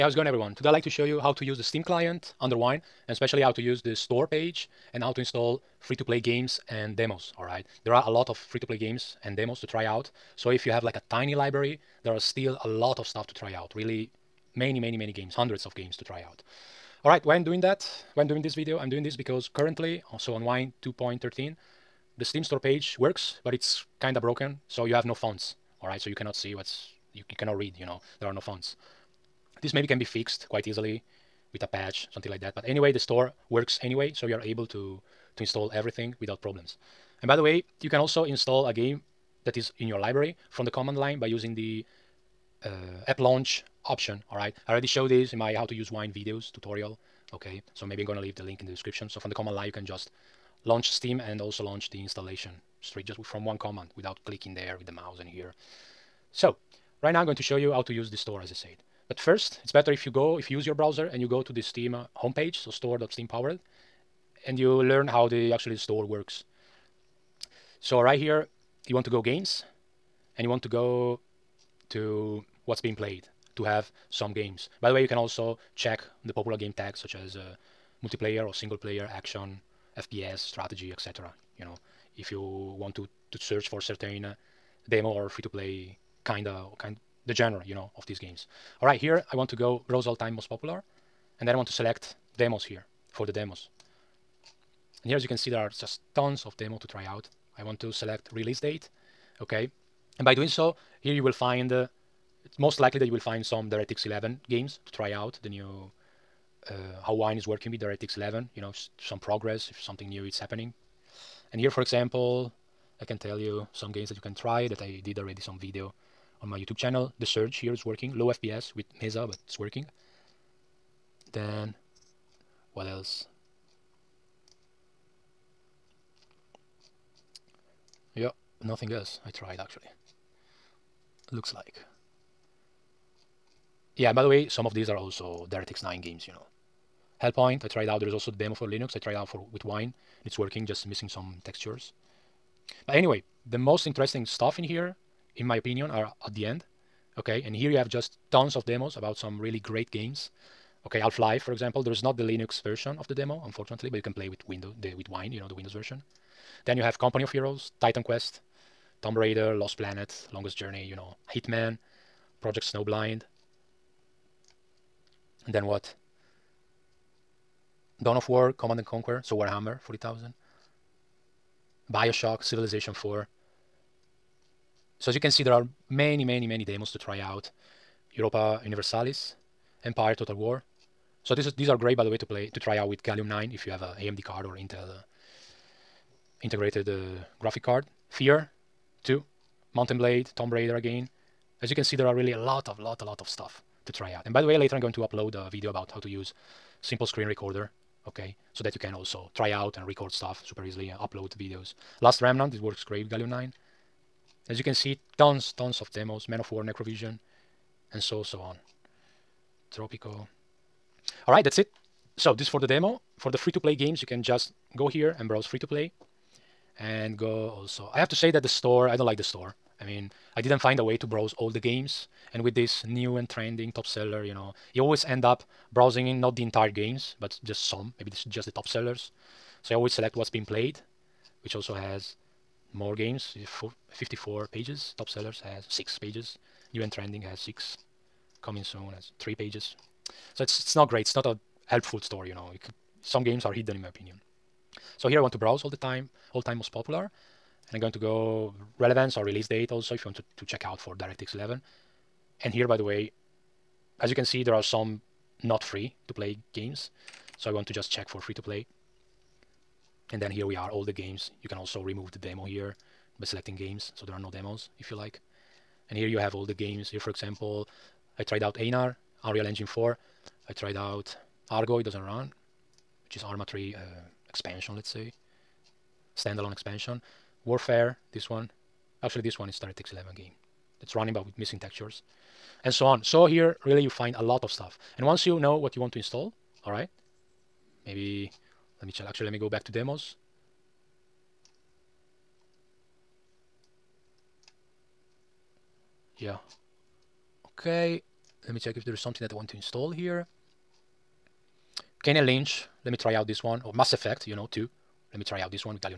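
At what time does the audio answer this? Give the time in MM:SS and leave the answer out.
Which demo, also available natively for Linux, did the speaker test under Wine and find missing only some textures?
02:17.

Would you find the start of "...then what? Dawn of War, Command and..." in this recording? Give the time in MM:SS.
02:45.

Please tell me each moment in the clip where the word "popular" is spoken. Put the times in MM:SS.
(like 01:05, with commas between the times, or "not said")
01:16, 01:30, 04:06.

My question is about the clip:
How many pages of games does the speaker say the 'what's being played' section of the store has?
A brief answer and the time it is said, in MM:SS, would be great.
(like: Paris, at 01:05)
54, at 03:53.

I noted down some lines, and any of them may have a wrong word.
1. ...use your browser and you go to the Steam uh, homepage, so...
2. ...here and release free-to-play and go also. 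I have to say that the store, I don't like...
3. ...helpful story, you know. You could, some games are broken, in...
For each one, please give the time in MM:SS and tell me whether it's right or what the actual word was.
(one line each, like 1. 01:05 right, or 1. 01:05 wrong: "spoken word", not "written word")
1. 01:00 right
2. 03:34 wrong: "browse", not "release"
3. 04:01 wrong: "hidden", not "broken".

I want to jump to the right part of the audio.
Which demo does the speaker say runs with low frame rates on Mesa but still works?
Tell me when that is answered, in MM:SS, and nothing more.
01:57.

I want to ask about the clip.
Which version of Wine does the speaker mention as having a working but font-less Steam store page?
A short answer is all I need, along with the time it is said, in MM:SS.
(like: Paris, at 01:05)
2.13, at 00:20.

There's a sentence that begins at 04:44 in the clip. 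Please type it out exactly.
And once you know what you want to install, all right, maybe let me check.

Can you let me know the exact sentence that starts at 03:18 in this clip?
So that you can also try out and record stuff super easily and upload videos.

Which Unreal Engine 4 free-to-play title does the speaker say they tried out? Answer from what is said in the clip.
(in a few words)
Einar.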